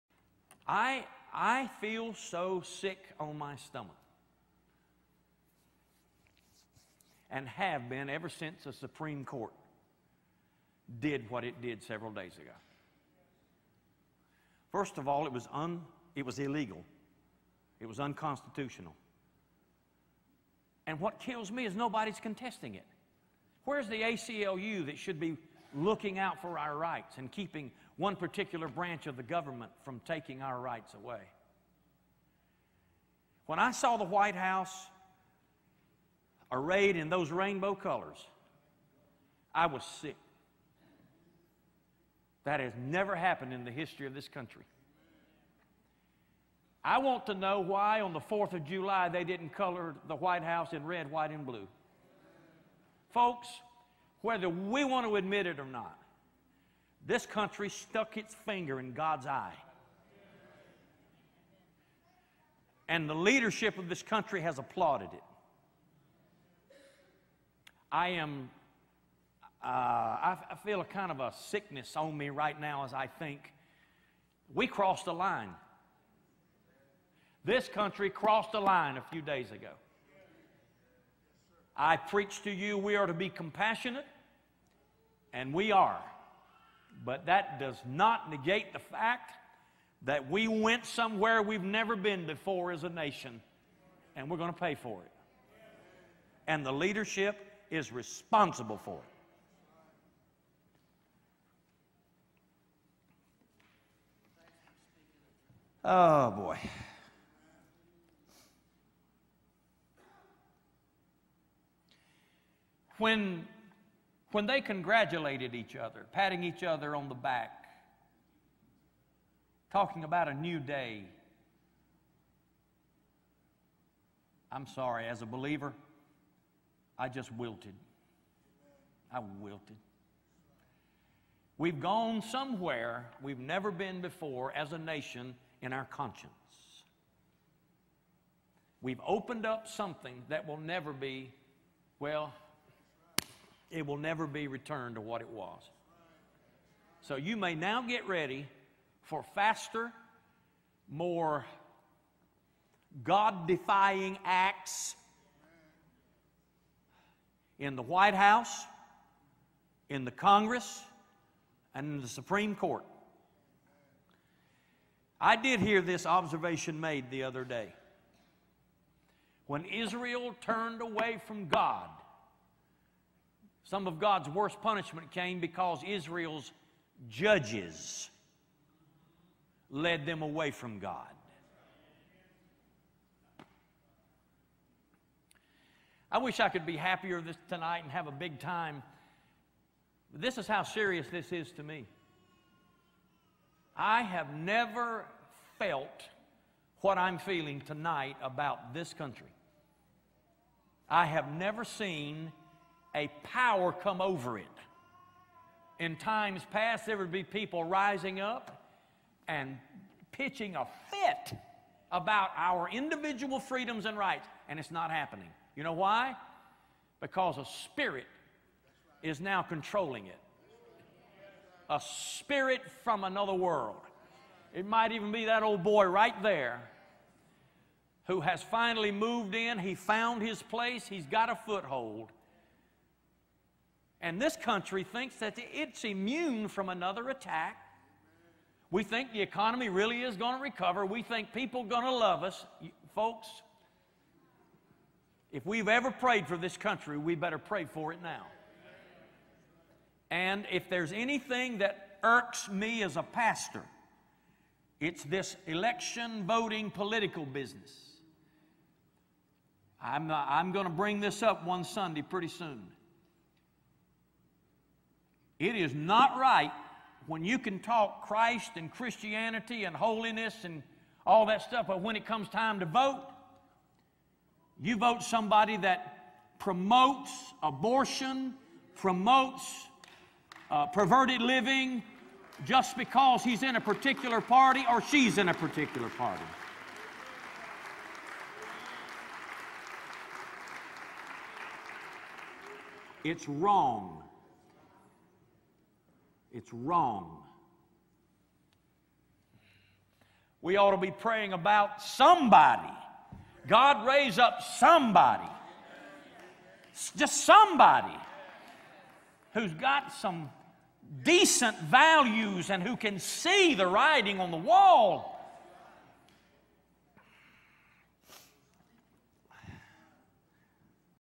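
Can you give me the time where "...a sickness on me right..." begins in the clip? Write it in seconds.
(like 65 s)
71 s.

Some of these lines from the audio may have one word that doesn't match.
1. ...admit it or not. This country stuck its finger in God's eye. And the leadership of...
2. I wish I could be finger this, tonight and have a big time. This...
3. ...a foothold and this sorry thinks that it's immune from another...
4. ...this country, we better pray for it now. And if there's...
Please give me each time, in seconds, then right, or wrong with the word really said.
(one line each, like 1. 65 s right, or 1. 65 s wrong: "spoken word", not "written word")
1. 55 s right
2. 186 s wrong: "happier", not "finger"
3. 231 s wrong: "country", not "sorry"
4. 246 s right.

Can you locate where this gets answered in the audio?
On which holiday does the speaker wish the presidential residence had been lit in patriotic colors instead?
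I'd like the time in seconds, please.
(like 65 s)
48 s.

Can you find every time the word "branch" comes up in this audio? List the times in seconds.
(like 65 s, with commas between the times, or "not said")
28 s.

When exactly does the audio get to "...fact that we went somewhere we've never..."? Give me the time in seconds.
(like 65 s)
88 s.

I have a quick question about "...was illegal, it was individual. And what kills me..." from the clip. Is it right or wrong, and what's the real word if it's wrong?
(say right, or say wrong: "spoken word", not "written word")
wrong: "unconstitutional", not "individual".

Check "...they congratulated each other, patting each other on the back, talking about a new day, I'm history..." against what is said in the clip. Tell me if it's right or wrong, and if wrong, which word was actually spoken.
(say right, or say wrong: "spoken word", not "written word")
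wrong: "sorry", not "history".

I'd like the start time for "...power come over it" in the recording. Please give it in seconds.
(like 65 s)
203 s.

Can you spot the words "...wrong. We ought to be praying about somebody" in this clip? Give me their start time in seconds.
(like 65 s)
296 s.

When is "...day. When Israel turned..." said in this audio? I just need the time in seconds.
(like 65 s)
167 s.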